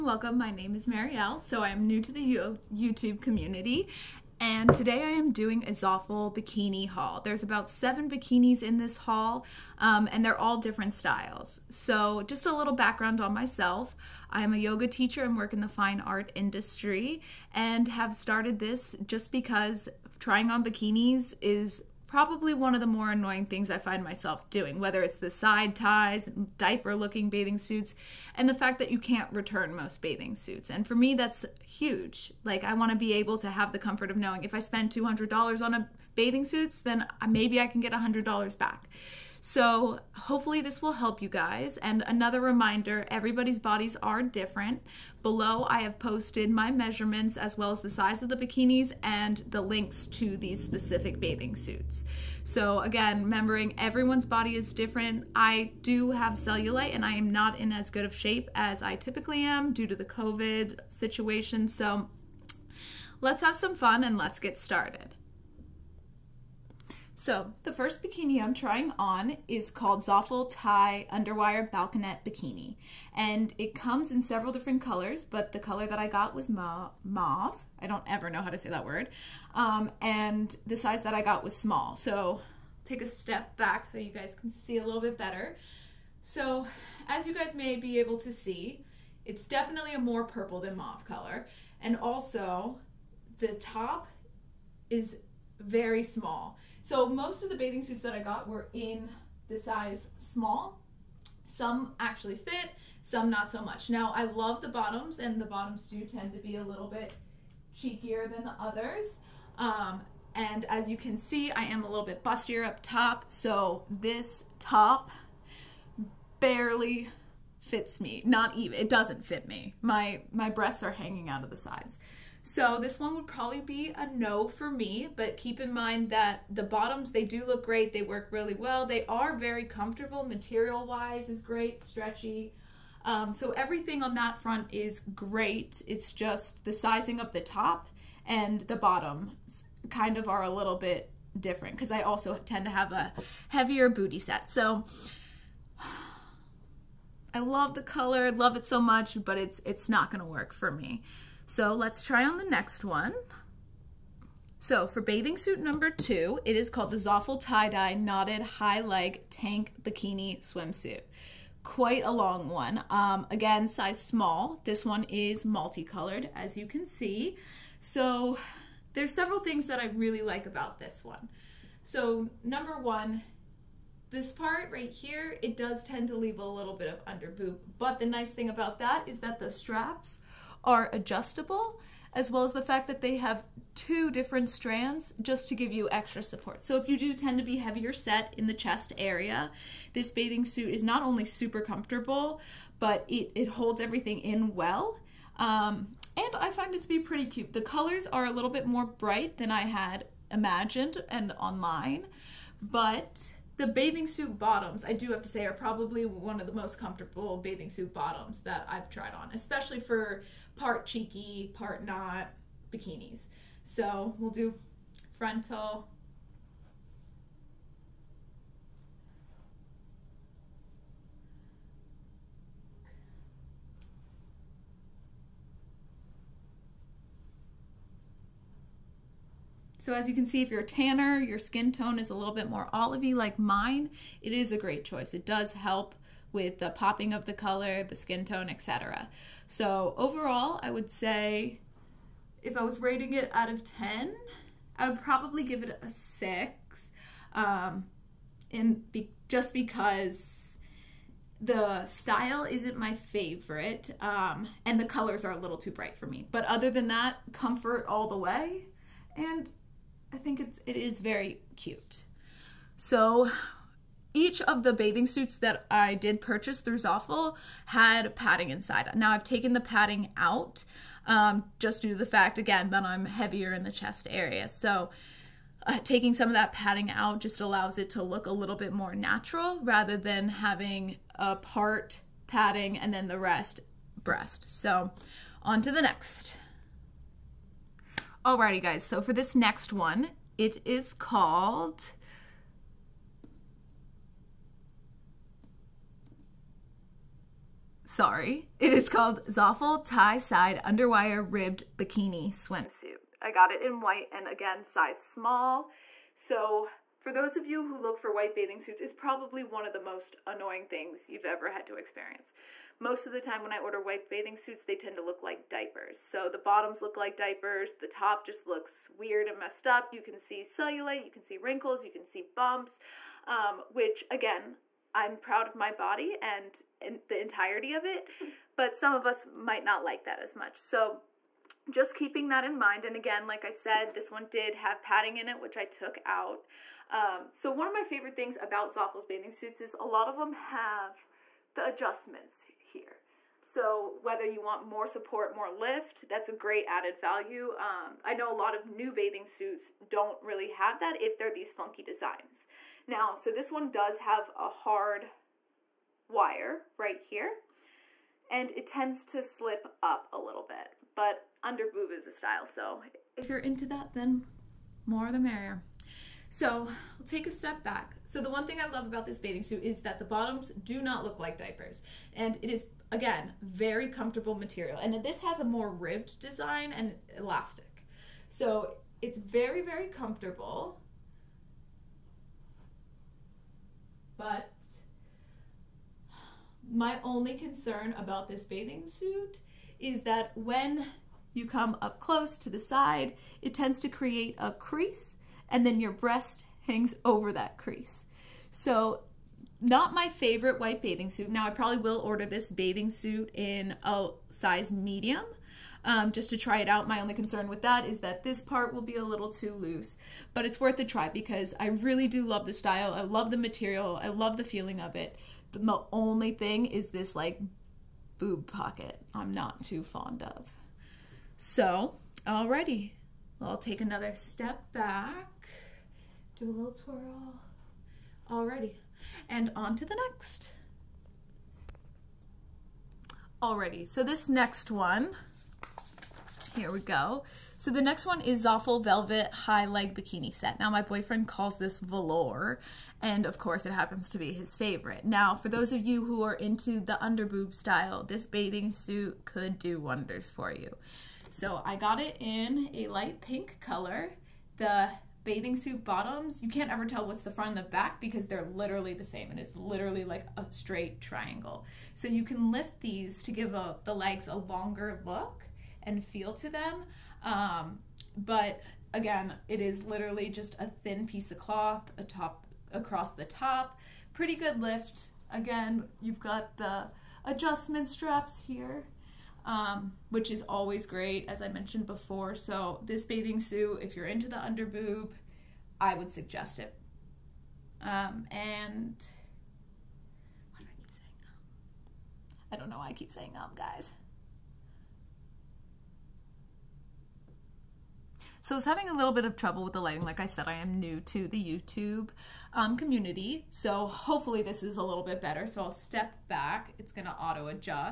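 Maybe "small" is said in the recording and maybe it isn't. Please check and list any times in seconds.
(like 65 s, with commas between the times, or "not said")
81 s, 96 s, 100 s, 164 s, 305 s.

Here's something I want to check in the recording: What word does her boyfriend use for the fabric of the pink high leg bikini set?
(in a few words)
velour.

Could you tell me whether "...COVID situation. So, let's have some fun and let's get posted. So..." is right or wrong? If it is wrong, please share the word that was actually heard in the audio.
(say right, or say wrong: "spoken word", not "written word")
wrong: "started", not "posted".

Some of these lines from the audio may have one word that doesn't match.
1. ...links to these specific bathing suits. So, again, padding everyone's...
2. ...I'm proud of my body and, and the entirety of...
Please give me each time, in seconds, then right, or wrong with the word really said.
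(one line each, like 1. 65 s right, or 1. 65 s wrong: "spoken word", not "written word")
1. 49 s wrong: "remembering", not "padding"
2. 324 s right.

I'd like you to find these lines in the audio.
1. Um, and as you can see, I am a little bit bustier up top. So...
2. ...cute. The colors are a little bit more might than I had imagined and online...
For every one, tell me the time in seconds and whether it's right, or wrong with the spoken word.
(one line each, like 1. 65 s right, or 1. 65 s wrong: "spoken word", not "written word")
1. 109 s right
2. 197 s wrong: "bright", not "might".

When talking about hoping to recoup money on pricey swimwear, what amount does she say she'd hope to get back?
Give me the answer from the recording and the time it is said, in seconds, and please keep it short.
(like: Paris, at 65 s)
$100, at 37 s.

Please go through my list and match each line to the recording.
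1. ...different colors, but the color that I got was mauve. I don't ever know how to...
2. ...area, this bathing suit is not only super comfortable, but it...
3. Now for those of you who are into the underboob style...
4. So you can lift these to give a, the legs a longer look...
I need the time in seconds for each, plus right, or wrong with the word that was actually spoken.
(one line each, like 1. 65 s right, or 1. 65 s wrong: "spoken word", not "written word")
1. 74 s right
2. 188 s right
3. 445 s right
4. 461 s right.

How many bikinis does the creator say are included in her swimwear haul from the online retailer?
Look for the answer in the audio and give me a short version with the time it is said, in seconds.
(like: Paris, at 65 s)
7, at 7 s.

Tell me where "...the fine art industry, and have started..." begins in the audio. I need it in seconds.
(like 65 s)
15 s.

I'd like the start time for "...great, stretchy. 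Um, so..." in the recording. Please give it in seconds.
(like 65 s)
131 s.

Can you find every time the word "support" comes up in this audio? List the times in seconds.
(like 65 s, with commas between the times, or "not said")
186 s, 344 s.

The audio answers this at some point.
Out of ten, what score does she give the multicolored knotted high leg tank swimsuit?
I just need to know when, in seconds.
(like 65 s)
245 s.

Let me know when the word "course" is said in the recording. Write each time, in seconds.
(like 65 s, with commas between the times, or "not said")
443 s.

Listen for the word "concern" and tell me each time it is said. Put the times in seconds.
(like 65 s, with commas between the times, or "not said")
387 s, 407 s.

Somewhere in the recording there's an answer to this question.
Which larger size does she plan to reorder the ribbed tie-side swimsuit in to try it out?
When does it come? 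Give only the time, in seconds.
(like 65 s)
404 s.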